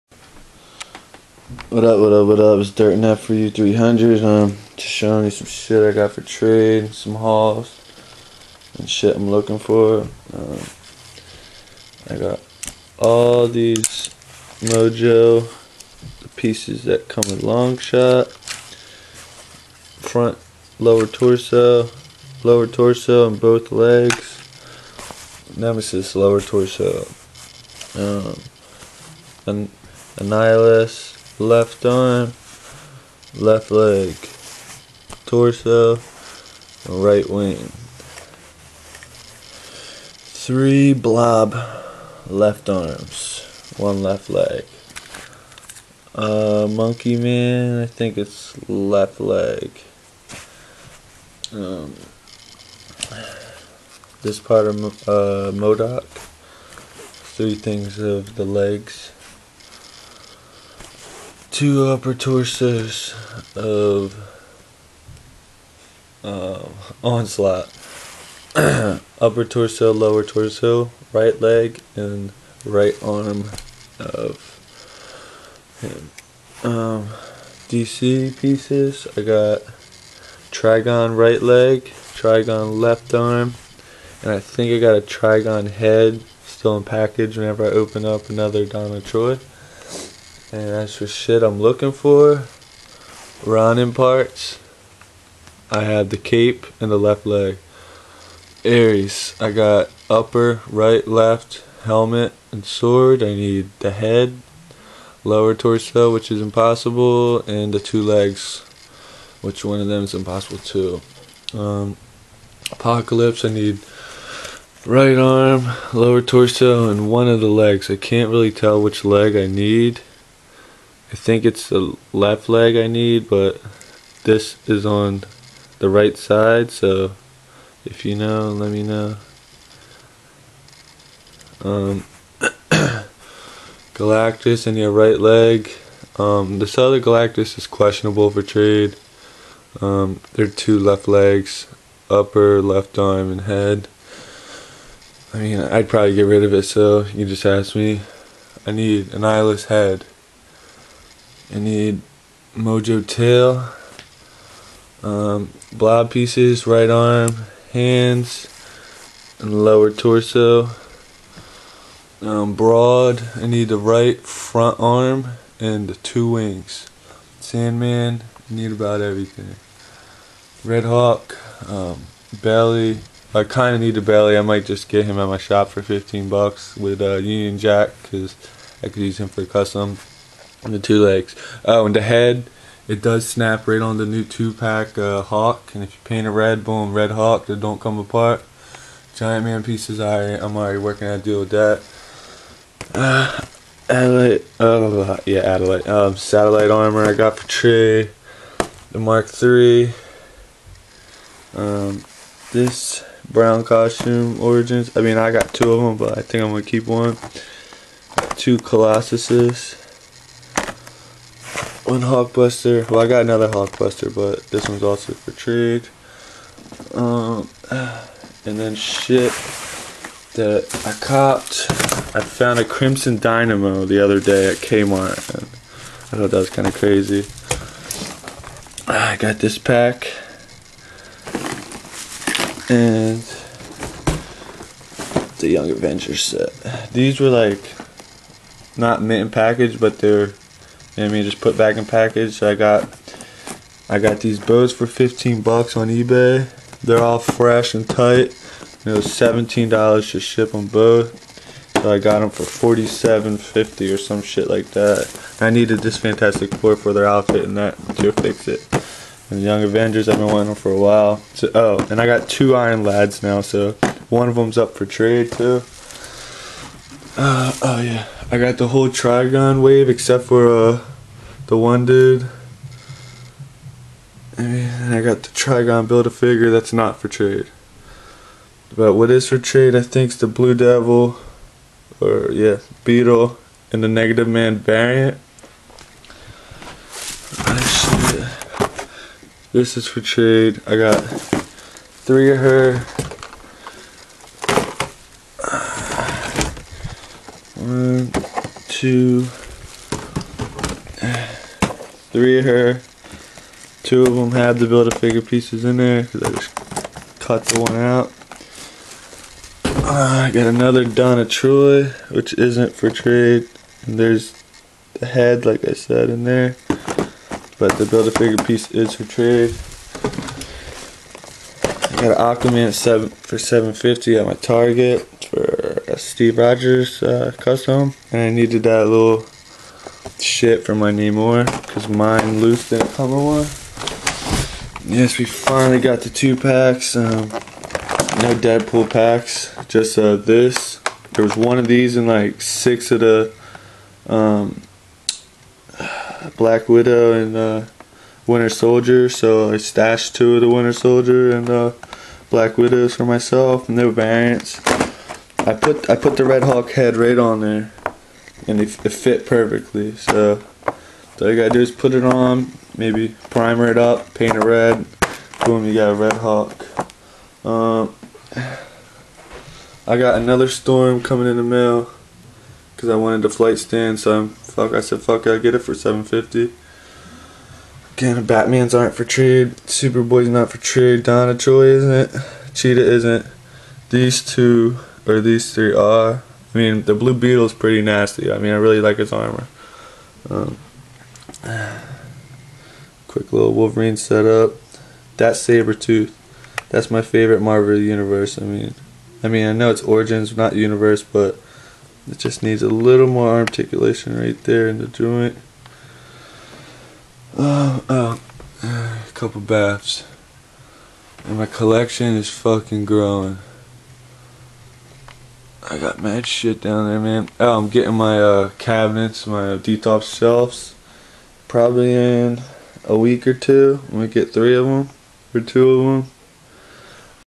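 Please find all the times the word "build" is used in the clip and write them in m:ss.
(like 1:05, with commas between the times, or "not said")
4:35, 5:04, 5:17.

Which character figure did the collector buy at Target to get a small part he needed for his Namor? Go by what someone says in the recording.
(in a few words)
Aquaman.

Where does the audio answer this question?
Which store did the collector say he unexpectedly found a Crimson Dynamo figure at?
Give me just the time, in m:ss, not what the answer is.
3:44.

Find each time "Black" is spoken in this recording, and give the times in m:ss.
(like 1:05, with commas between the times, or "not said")
5:46, 5:52.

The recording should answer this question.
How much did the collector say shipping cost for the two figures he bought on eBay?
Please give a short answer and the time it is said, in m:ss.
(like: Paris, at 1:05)
$17, at 4:09.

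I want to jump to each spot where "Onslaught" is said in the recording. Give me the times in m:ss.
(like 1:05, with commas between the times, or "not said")
1:07.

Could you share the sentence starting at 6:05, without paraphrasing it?
Boom, you got a Red Hulk.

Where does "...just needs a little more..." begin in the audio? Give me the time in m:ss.
6:42.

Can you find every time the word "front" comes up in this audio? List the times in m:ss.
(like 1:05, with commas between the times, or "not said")
0:20, 2:44.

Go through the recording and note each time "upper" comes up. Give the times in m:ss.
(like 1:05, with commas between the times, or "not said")
1:01, 1:09, 1:40, 2:22.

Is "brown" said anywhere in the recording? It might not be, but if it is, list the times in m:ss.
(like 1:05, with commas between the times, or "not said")
3:23.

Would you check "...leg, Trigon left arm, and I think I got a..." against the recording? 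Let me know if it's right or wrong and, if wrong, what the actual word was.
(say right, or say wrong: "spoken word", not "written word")
right.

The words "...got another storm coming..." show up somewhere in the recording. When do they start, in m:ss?
6:09.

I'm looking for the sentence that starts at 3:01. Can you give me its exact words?
Oh, and the head, it does snap right on the new two pack uh, Hulk.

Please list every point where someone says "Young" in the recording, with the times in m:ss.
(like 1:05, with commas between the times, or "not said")
3:55, 4:19.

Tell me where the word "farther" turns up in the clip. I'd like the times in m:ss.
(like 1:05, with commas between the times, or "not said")
not said.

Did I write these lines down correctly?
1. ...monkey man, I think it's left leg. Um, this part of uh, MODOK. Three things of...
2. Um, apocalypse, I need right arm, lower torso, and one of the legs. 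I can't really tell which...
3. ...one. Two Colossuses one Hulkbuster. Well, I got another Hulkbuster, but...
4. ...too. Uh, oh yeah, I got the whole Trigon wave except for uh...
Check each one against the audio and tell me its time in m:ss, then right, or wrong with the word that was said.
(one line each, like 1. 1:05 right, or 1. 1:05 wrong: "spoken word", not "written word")
1. 0:46 right
2. 1:51 right
3. 3:26 right
4. 4:25 right.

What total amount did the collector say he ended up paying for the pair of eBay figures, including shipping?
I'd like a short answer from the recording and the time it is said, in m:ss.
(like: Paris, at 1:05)
$47.50, at 4:12.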